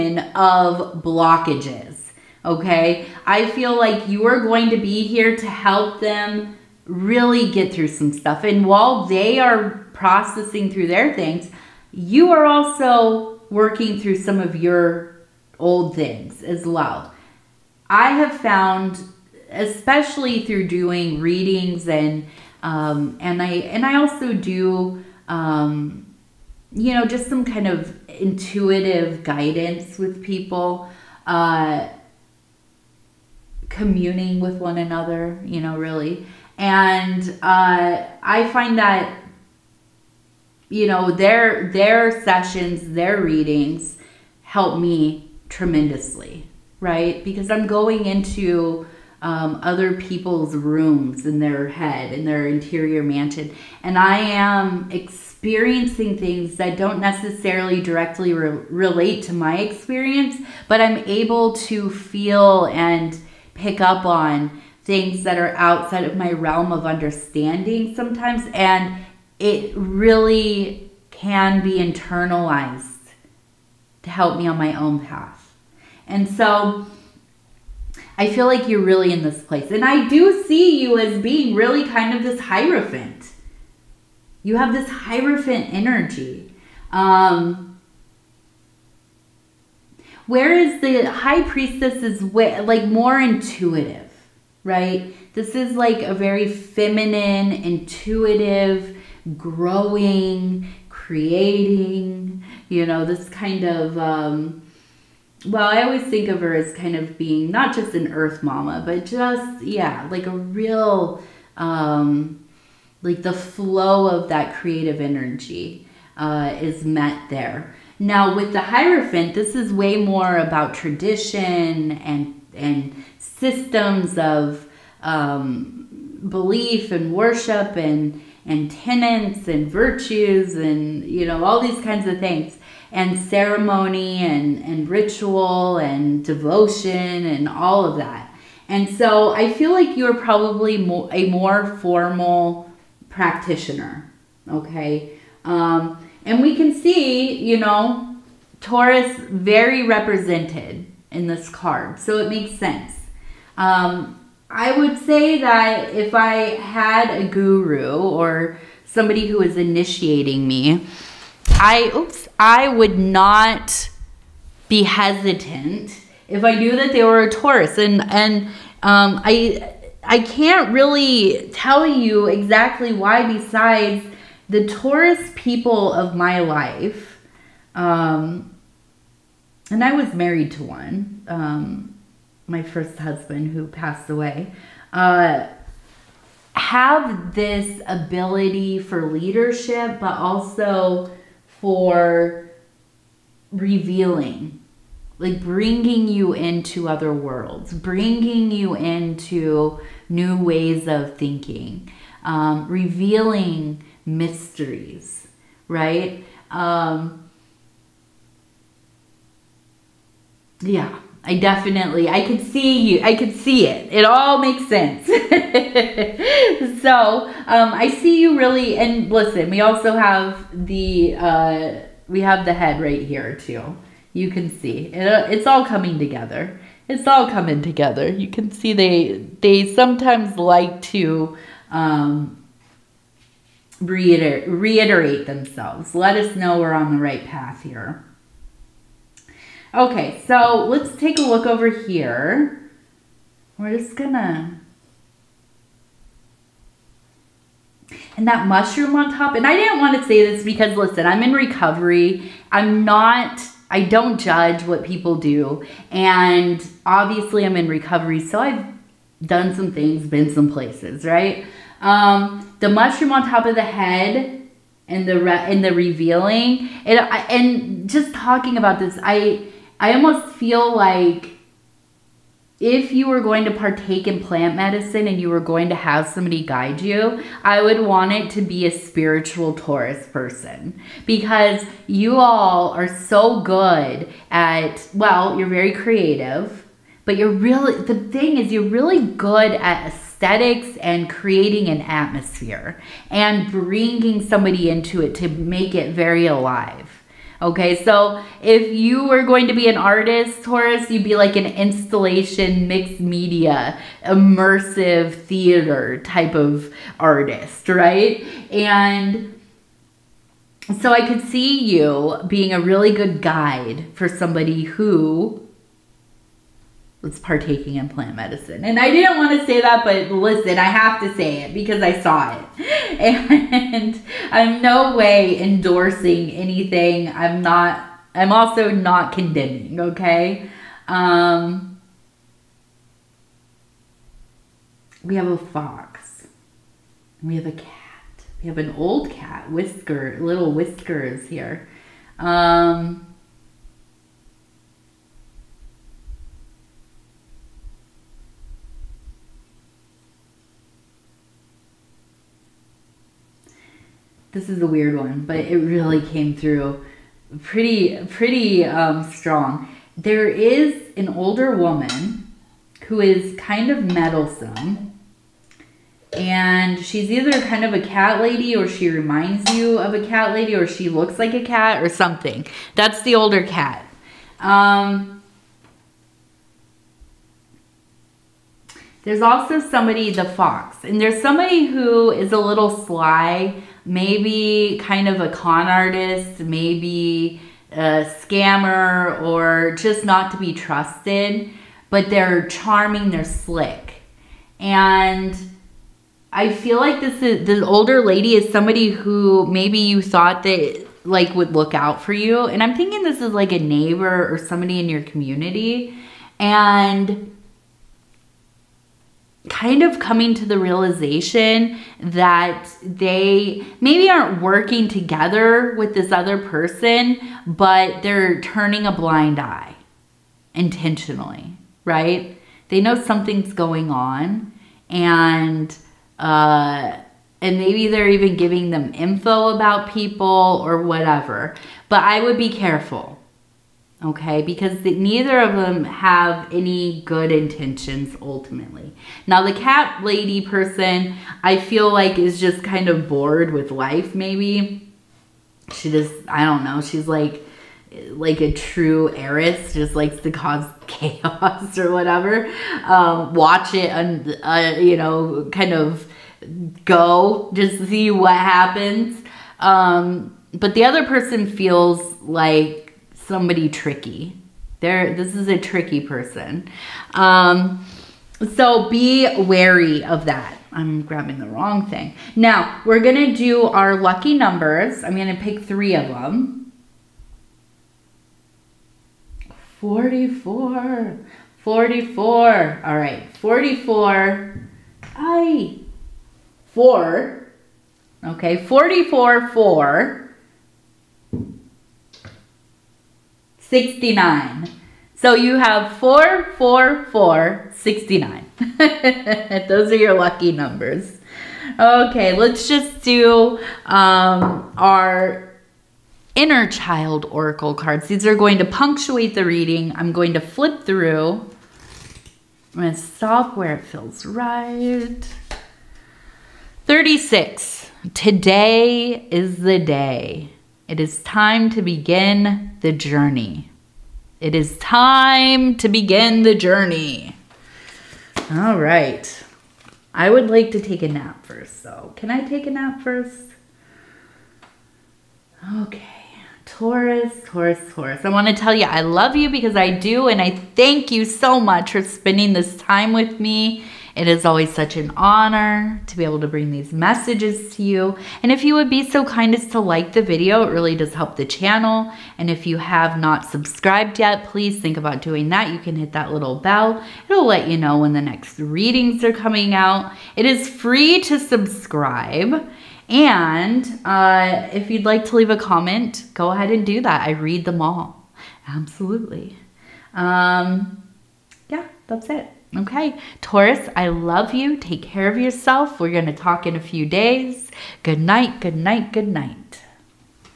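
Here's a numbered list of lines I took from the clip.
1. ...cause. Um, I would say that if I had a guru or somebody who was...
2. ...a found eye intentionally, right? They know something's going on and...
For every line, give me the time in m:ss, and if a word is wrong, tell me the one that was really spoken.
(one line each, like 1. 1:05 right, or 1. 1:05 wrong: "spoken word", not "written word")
1. 2:32 wrong: "sense", not "cause"
2. 6:58 wrong: "blind", not "found".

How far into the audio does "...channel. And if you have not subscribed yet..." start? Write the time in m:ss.
9:11.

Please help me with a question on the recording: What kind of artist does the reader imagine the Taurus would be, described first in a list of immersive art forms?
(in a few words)
installation.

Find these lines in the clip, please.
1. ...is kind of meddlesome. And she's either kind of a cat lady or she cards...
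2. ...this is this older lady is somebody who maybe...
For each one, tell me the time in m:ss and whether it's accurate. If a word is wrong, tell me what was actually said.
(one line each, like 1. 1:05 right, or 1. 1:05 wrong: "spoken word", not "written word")
1. 6:03 wrong: "reminds", not "cards"
2. 6:37 right.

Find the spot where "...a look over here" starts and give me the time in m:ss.
4:01.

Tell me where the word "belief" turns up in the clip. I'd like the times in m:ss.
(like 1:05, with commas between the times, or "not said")
2:06.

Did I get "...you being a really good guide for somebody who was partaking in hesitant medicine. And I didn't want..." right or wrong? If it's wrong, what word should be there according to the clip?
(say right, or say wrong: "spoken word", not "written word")
wrong: "plant", not "hesitant".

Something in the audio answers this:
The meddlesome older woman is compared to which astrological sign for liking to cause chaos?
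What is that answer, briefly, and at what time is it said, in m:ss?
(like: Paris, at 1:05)
Aries, at 7:28.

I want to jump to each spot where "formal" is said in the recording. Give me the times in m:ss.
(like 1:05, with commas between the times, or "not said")
2:21.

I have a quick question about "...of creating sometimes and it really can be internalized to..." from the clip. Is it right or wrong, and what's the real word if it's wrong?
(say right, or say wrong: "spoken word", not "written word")
wrong: "understanding", not "creating".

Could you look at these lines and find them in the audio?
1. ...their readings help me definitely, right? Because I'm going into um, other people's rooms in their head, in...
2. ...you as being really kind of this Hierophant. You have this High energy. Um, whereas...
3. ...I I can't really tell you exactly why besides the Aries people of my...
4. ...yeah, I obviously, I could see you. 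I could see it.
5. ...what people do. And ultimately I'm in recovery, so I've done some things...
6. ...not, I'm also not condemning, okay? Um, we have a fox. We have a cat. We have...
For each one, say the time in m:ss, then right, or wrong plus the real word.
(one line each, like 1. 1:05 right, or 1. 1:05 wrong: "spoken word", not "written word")
1. 0:42 wrong: "tremendously", not "definitely"
2. 1:20 wrong: "Hierophant", not "High"
3. 2:49 wrong: "Taurus", not "Aries"
4. 3:30 wrong: "definitely", not "obviously"
5. 4:14 wrong: "obviously", not "ultimately"
6. 5:27 right.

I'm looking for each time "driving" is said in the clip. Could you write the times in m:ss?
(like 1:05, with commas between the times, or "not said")
not said.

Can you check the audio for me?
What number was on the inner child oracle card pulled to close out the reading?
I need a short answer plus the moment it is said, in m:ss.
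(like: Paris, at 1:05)
36, at 8:36.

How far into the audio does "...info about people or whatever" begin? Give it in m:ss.
7:08.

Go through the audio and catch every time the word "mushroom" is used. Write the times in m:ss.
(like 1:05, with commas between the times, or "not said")
4:08, 4:22.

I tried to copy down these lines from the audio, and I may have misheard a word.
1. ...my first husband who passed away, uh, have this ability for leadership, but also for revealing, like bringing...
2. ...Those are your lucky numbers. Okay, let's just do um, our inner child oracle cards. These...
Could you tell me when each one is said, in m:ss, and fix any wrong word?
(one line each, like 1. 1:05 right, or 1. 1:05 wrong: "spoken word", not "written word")
1. 3:02 right
2. 8:19 right.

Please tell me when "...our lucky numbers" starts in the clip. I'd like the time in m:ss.
7:53.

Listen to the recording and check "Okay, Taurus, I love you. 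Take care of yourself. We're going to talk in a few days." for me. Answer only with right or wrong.
right.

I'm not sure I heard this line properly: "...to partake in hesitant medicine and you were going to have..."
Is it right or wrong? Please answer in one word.
wrong.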